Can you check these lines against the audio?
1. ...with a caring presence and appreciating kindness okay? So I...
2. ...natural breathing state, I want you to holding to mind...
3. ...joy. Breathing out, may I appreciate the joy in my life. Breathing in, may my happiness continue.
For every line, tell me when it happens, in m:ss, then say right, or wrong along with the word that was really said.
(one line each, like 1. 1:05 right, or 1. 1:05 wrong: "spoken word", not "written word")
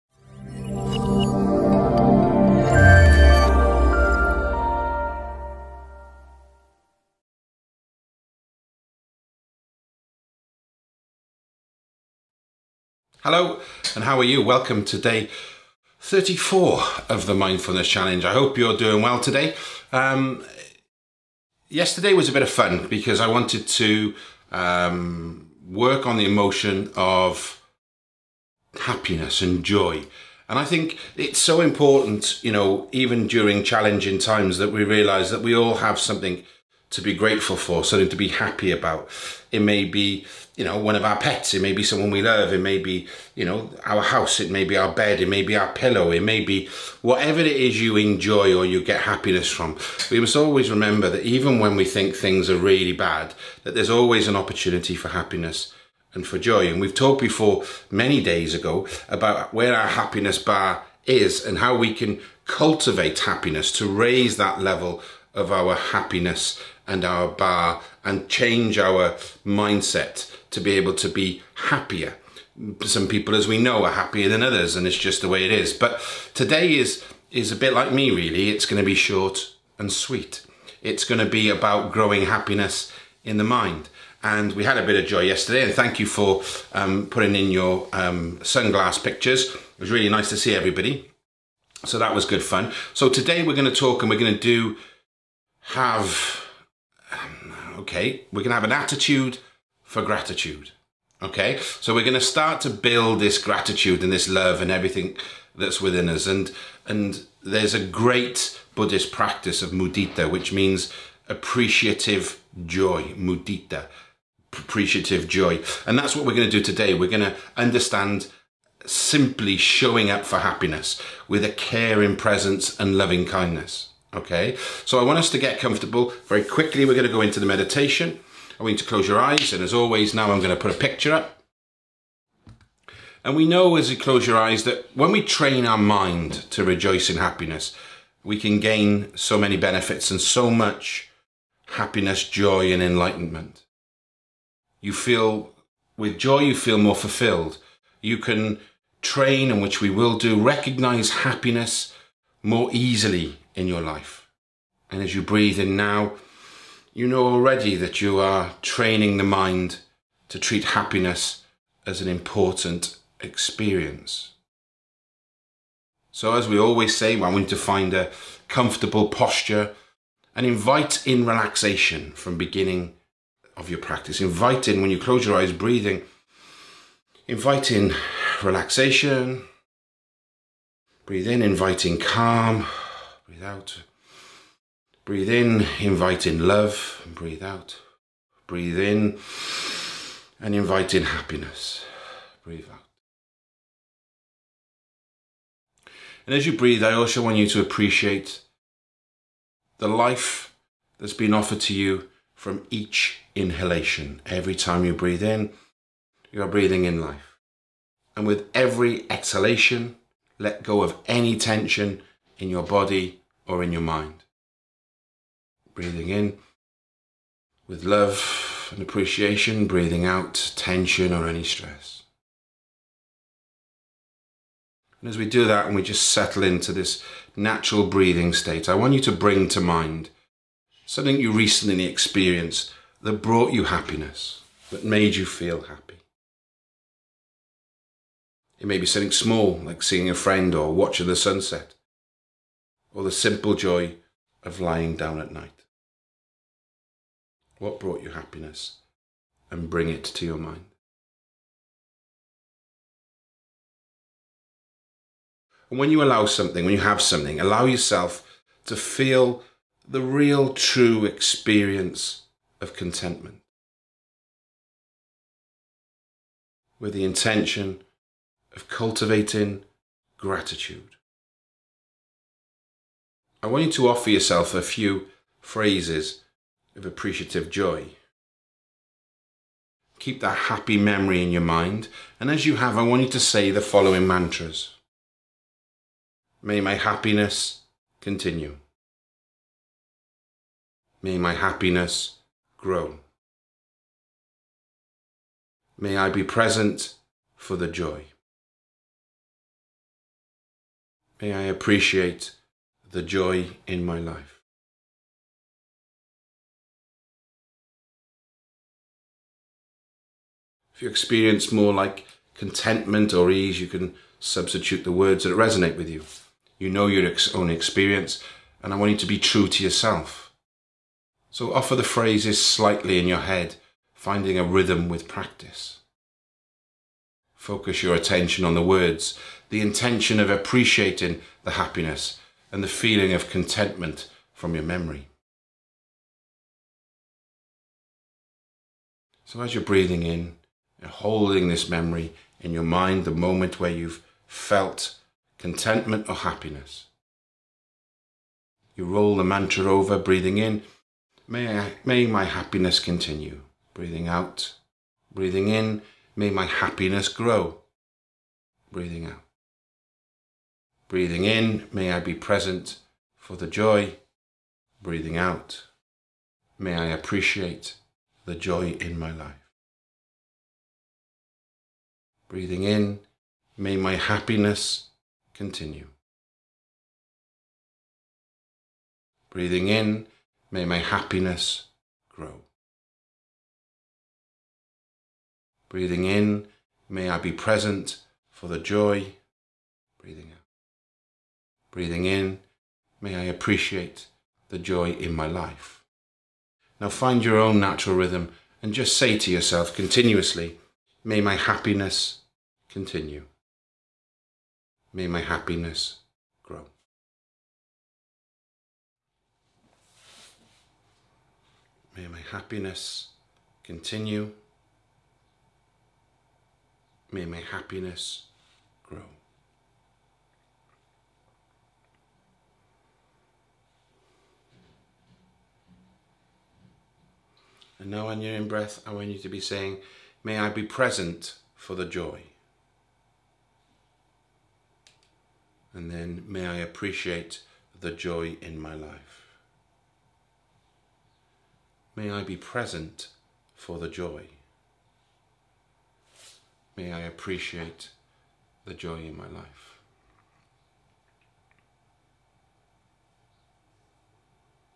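1. 2:01 wrong: "loving", not "appreciating"
2. 3:47 wrong: "bring", not "holding"
3. 6:03 right.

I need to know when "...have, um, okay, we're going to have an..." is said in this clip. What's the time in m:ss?
1:35.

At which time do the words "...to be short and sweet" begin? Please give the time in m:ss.
1:18.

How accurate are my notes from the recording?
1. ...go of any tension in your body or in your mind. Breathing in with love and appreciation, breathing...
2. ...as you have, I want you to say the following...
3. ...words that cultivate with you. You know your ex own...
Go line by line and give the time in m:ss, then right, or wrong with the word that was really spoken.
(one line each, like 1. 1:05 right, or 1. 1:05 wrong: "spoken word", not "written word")
1. 3:30 right
2. 4:42 right
3. 5:14 wrong: "resonate", not "cultivate".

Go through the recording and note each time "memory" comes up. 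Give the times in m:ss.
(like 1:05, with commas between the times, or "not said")
4:40, 5:34, 5:41.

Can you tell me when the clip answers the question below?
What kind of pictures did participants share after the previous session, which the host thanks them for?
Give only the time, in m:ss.
1:28.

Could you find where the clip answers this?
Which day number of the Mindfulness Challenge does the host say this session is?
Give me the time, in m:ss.
0:14.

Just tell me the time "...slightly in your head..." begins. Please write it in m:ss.
5:22.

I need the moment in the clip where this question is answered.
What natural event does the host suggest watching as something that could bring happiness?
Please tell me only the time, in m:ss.
4:01.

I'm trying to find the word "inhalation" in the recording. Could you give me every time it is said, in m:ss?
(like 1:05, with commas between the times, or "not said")
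3:23.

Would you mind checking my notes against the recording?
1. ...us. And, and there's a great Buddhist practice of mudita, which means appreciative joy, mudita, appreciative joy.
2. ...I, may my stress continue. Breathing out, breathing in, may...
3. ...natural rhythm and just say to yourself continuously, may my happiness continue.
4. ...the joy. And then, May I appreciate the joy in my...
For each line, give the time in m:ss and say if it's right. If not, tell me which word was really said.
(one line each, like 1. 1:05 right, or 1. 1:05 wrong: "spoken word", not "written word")
1. 1:46 right
2. 5:51 wrong: "happiness", not "stress"
3. 6:37 right
4. 7:11 right.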